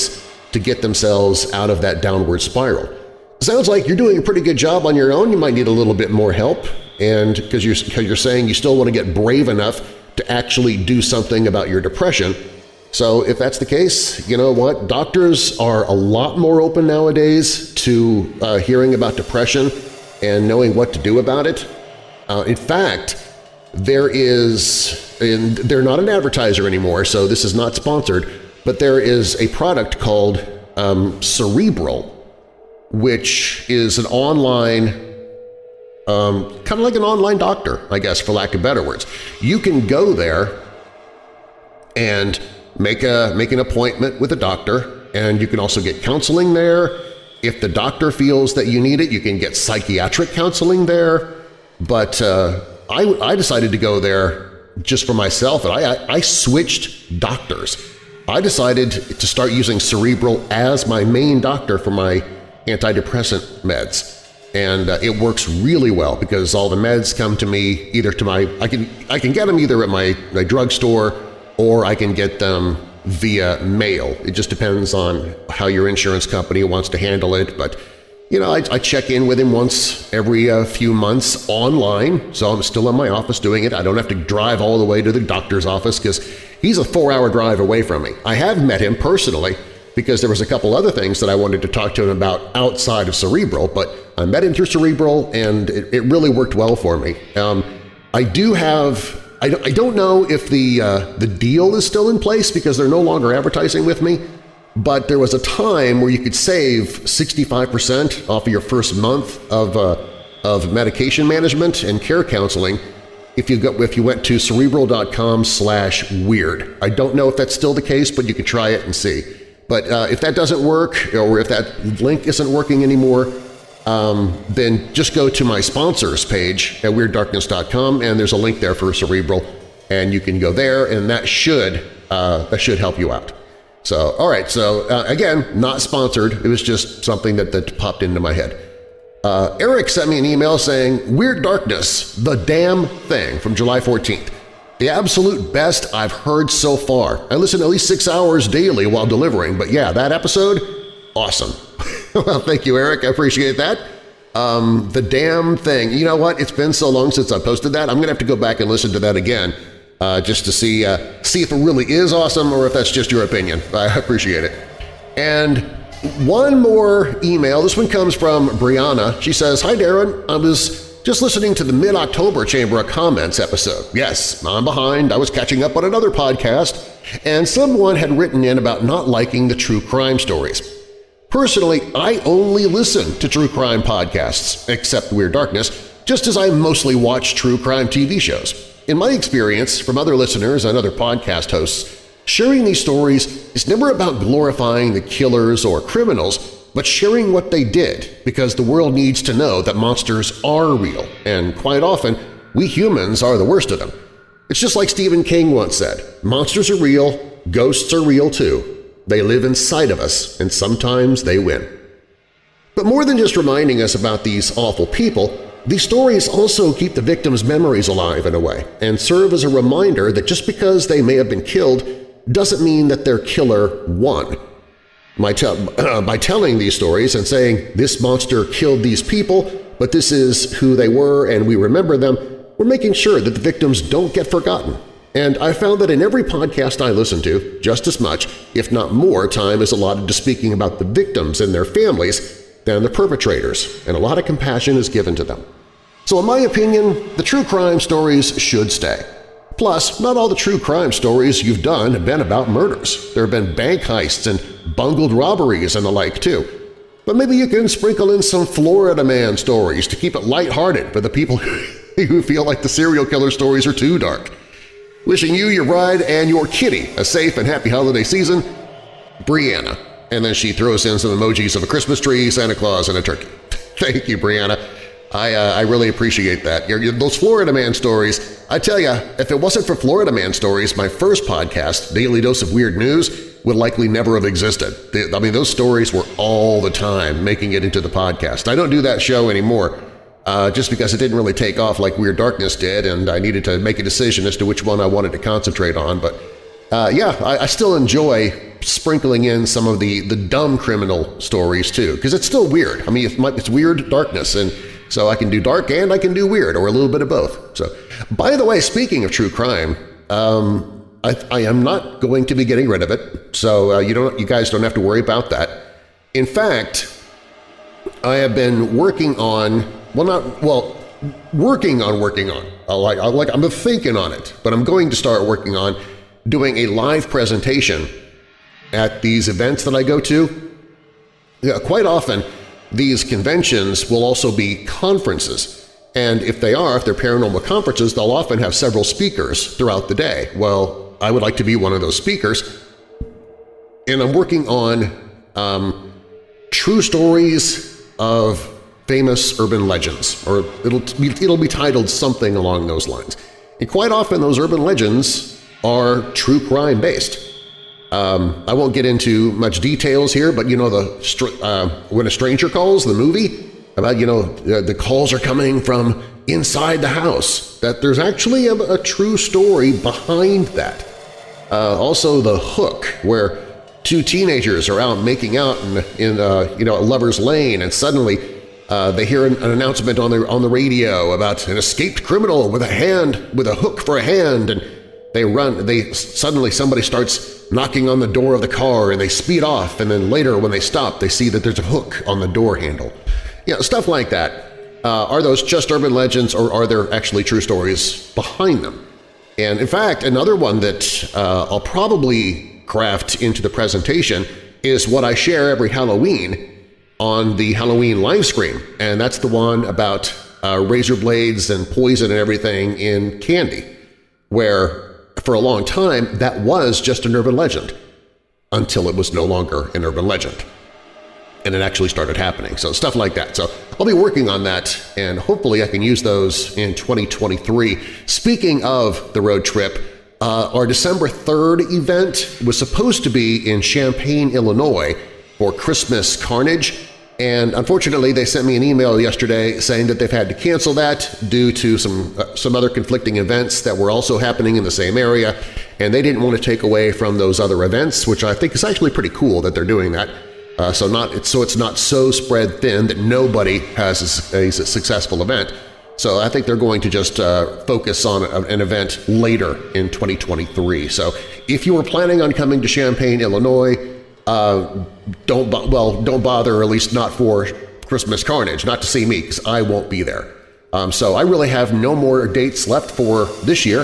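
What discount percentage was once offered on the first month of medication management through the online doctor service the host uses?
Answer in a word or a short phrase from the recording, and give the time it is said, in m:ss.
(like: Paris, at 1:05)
65%, at 1:47.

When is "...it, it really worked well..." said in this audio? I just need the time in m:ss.
1:35.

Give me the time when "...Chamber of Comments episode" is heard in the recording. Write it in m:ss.
2:52.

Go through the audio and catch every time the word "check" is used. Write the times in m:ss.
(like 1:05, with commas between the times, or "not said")
1:18.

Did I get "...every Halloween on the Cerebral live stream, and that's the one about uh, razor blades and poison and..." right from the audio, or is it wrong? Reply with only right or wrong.
wrong.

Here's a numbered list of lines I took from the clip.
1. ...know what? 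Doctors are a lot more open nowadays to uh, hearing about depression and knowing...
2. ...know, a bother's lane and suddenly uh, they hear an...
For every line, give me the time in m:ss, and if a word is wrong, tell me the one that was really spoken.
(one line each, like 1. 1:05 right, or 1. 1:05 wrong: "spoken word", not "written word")
1. 0:14 right
2. 6:16 wrong: "lover", not "bother".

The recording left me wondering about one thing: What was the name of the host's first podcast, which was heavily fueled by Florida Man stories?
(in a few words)
Daily Dose of Weird News.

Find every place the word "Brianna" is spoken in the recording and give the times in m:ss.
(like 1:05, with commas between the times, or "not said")
2:48, 4:29, 4:34.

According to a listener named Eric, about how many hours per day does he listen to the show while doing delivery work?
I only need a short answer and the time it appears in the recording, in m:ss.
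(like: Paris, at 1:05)
6 hours, at 2:27.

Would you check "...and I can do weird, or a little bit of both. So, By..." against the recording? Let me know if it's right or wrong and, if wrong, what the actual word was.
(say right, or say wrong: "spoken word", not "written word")
right.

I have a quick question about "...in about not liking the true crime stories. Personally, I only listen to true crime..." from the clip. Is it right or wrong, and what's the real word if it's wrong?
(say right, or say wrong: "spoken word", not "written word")
right.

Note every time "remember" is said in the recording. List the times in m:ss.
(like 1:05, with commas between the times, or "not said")
3:51.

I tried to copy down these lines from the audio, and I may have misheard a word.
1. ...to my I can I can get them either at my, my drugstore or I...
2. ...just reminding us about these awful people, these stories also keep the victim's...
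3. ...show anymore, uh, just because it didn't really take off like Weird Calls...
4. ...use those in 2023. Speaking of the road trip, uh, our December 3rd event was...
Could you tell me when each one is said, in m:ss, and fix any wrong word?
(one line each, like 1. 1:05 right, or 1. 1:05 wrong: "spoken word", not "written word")
1. 1:08 right
2. 3:33 right
3. 4:49 wrong: "Darkness", not "Calls"
4. 7:05 right.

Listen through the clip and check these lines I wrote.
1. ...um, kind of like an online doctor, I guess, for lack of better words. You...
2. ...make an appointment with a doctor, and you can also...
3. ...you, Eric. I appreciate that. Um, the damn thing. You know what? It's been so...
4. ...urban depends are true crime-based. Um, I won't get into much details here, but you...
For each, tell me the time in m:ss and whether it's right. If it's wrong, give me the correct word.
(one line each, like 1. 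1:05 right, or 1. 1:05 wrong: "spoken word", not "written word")
1. 0:36 right
2. 0:43 right
3. 2:32 right
4. 5:54 wrong: "legends", not "depends".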